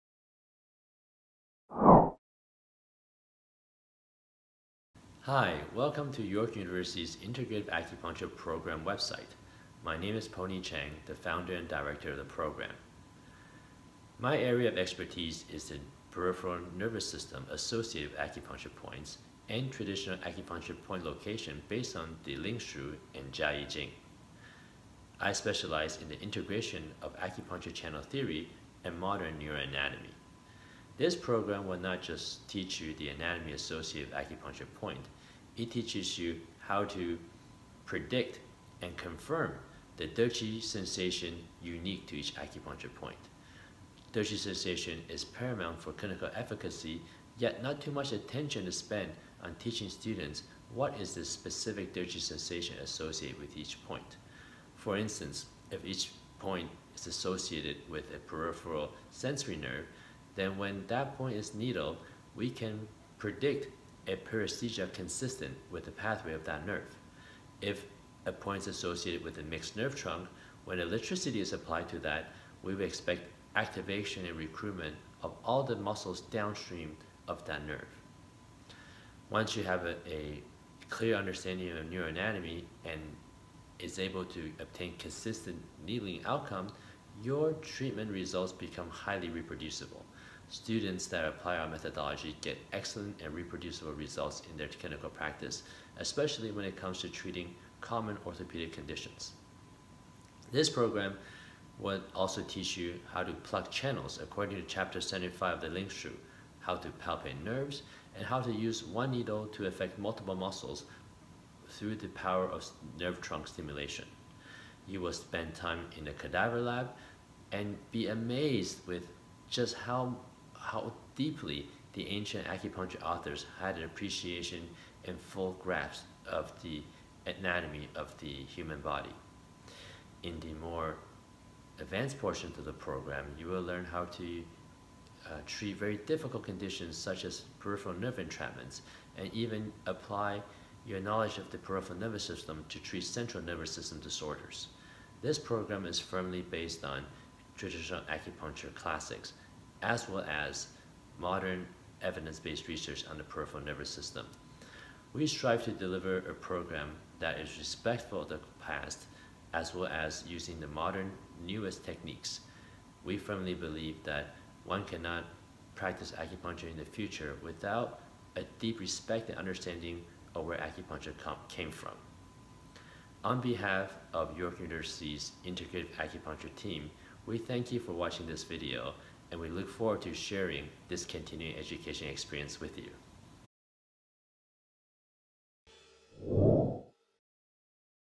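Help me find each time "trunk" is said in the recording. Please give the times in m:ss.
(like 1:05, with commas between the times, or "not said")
1:09, 1:53.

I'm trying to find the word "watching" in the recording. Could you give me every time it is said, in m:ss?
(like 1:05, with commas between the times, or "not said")
2:57.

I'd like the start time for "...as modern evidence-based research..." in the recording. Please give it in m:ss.
2:30.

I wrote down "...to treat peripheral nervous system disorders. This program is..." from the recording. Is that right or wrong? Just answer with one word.
wrong.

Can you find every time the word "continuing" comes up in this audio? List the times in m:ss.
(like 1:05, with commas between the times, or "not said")
3:01.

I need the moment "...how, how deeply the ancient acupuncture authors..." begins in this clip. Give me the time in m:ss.
1:59.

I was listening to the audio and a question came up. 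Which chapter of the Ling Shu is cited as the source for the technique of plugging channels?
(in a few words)
75.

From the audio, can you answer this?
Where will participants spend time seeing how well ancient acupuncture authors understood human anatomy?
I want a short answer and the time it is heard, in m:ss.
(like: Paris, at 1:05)
cadaver lab, at 1:56.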